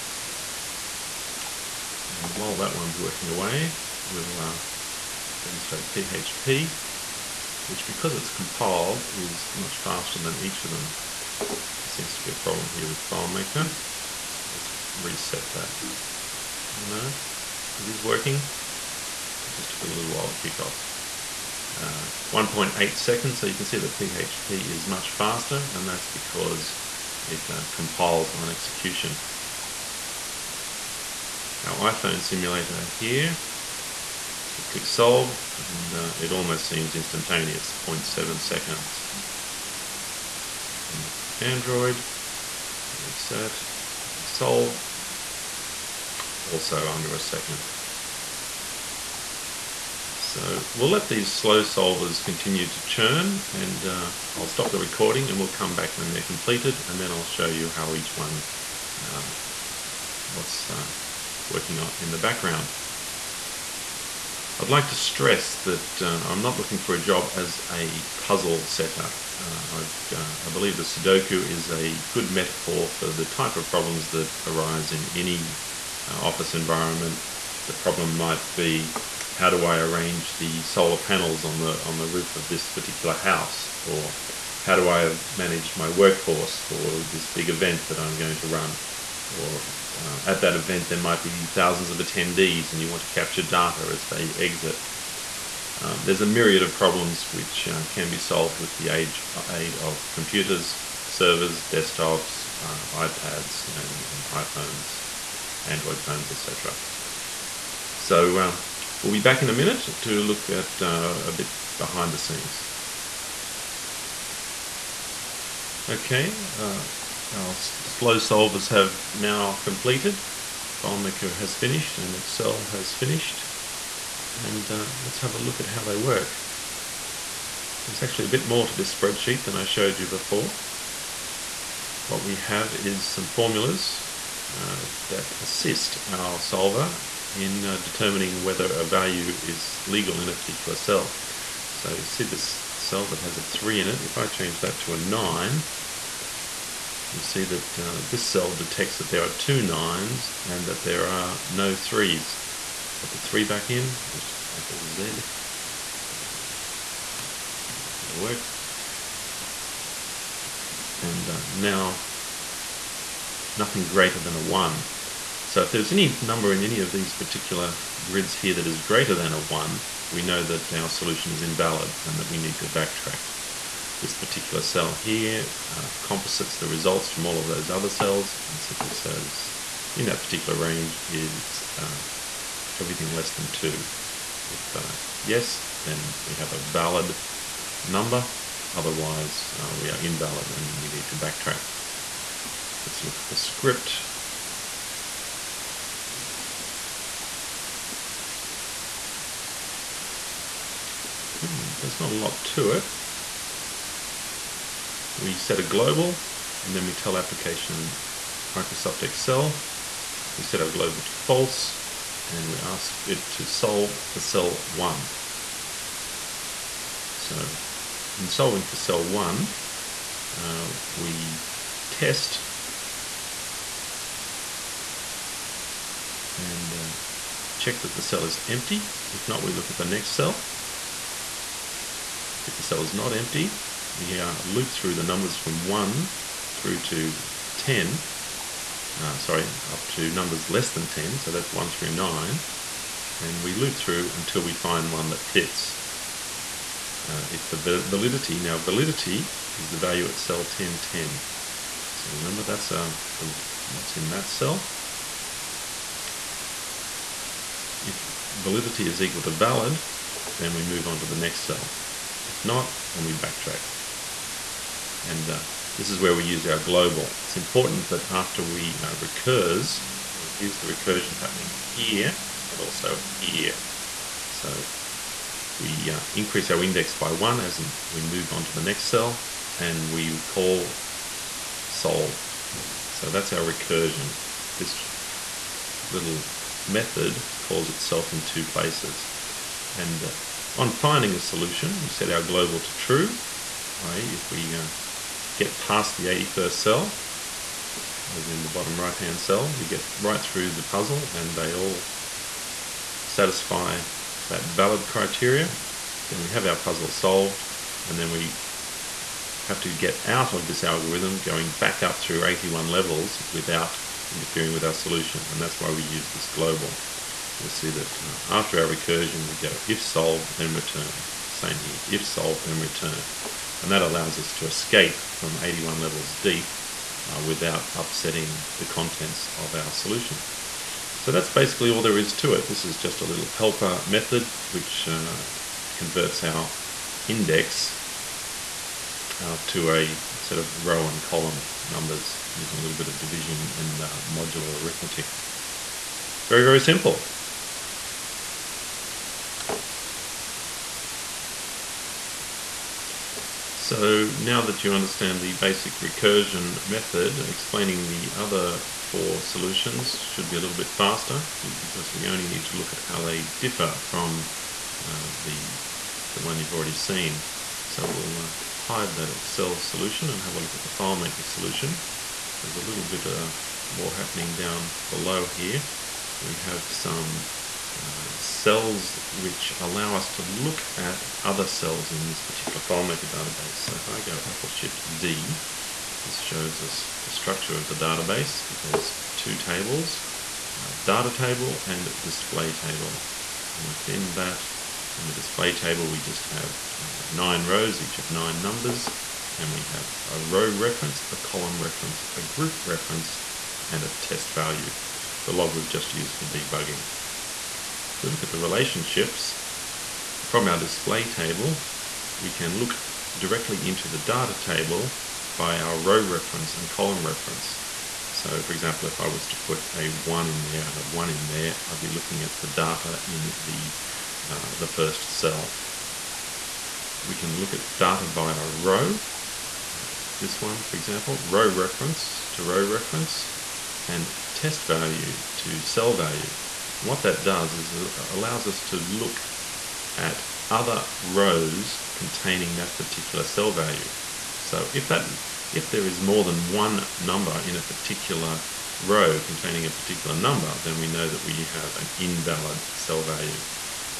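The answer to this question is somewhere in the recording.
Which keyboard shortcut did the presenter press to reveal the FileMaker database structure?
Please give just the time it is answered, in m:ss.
6:24.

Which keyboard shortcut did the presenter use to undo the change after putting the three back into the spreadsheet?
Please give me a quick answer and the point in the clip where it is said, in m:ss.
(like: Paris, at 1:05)
Apple Z, at 2:34.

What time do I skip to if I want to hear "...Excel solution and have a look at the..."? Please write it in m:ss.
6:09.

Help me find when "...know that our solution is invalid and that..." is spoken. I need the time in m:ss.
2:50.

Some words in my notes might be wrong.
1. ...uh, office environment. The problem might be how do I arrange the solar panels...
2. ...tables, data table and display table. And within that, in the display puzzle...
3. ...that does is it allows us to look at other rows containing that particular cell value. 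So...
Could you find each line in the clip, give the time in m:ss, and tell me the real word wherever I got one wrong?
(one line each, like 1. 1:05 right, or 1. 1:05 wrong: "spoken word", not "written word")
1. 1:16 right
2. 6:29 wrong: "table", not "puzzle"
3. 7:17 right.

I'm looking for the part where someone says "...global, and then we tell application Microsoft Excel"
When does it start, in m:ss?
3:25.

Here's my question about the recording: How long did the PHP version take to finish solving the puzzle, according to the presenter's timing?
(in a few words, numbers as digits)
1.8 seconds.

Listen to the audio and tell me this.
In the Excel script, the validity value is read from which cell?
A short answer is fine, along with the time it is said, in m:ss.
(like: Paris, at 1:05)
1010, at 4:10.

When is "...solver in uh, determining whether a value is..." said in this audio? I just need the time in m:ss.
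2:16.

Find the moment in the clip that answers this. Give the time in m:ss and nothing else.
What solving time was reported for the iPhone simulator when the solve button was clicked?
0:37.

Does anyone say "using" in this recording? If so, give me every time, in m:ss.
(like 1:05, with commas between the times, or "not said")
5:42.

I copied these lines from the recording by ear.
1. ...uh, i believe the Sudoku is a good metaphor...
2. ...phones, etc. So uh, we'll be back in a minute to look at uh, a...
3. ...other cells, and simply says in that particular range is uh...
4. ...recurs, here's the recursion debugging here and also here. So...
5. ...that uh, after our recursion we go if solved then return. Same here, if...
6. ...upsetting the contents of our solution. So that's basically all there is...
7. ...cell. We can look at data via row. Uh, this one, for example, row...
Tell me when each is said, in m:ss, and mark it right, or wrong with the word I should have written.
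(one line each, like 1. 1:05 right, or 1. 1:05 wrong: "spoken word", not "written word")
1. 1:10 right
2. 1:46 right
3. 2:57 right
4. 4:28 wrong: "happening", not "debugging"
5. 5:17 right
6. 5:27 right
7. 7:05 right.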